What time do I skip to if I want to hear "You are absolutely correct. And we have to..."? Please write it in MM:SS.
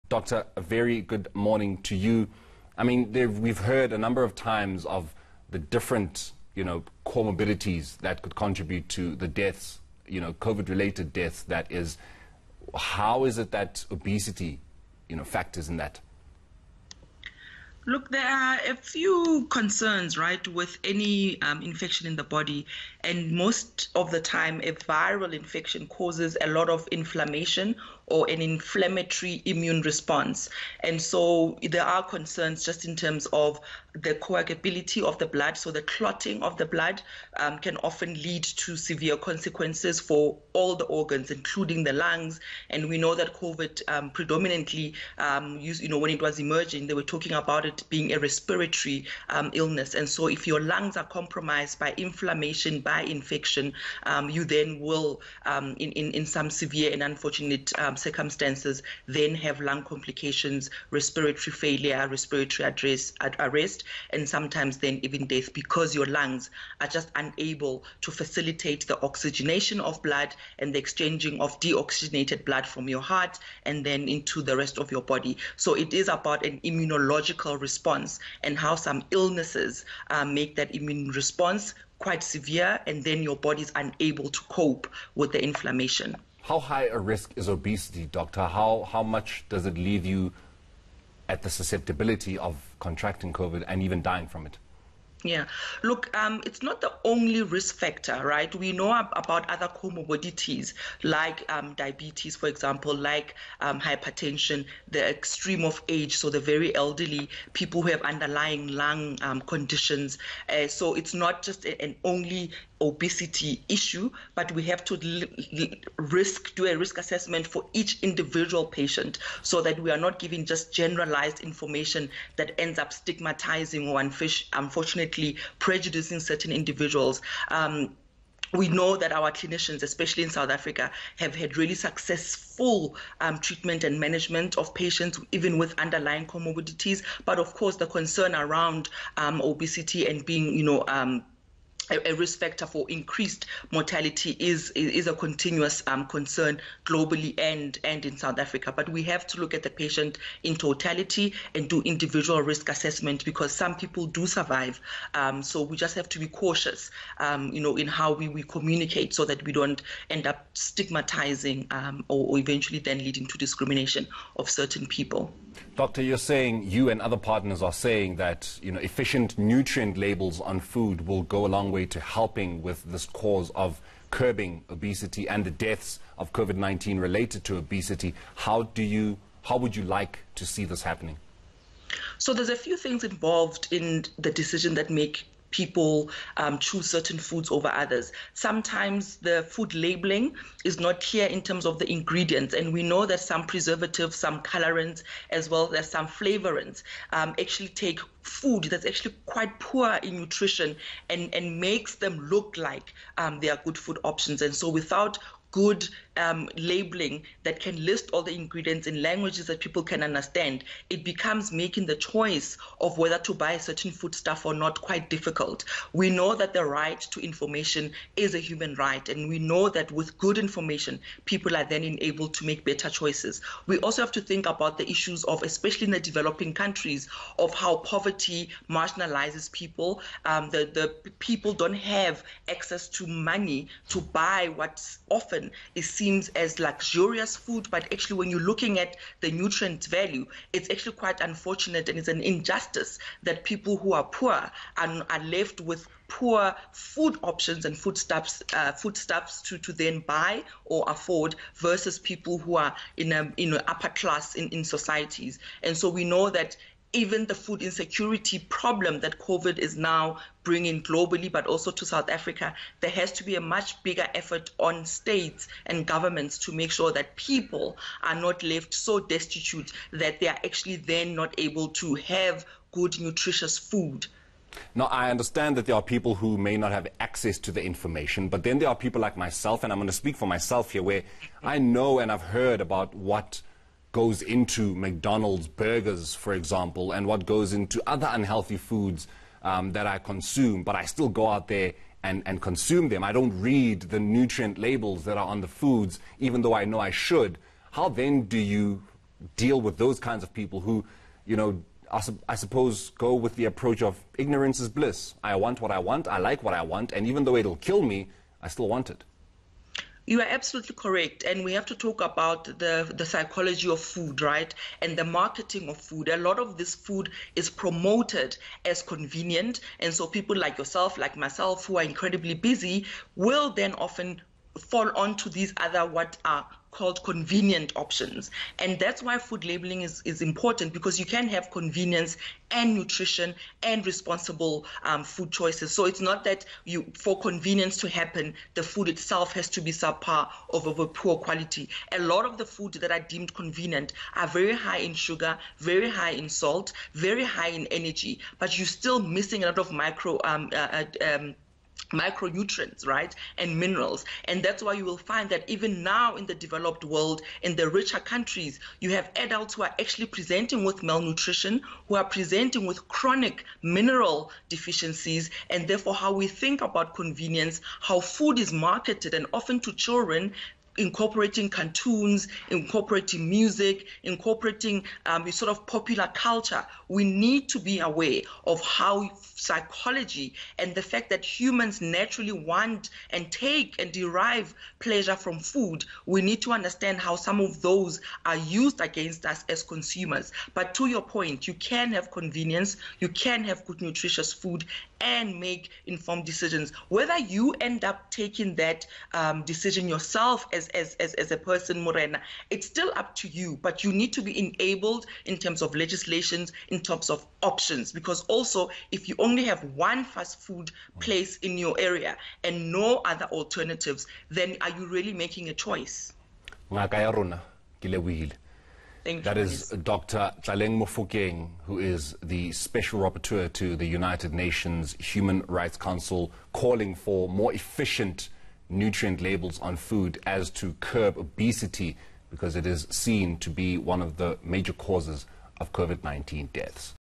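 05:10.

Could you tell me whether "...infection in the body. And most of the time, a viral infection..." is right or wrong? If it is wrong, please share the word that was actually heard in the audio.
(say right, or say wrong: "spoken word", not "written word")
right.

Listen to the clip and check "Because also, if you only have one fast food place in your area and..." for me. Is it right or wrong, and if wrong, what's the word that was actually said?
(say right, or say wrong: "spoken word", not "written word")
right.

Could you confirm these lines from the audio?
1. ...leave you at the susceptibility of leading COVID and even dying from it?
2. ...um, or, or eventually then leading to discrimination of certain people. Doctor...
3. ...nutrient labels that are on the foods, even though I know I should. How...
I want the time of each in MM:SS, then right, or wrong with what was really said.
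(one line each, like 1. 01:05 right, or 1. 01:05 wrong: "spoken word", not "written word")
1. 01:29 wrong: "contracting", not "leading"
2. 02:41 right
3. 04:53 right.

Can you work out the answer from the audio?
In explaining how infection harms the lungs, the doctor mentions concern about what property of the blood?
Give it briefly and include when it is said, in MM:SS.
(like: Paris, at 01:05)
coagulability, at 00:34.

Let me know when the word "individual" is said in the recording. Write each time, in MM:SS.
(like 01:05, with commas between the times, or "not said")
01:58, 02:06, 02:31.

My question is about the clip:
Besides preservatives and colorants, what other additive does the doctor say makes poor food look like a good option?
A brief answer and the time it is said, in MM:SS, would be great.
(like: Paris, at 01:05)
flavorants, at 03:16.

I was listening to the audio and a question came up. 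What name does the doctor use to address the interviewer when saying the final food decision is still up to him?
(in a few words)
Morena.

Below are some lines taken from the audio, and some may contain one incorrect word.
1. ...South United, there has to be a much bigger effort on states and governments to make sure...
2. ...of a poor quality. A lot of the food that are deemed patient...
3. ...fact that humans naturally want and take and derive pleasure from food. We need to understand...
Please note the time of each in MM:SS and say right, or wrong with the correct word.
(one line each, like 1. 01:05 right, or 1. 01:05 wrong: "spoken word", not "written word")
1. 04:21 wrong: "Africa", not "United"
2. 05:40 wrong: "convenient", not "patient"
3. 06:20 right.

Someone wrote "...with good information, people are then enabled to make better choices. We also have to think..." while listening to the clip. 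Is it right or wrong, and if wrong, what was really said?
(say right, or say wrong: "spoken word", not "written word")
right.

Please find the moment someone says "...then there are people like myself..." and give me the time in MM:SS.
04:38.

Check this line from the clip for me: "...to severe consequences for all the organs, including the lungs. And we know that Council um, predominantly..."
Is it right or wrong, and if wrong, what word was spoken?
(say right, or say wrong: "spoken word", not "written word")
wrong: "COVID", not "Council".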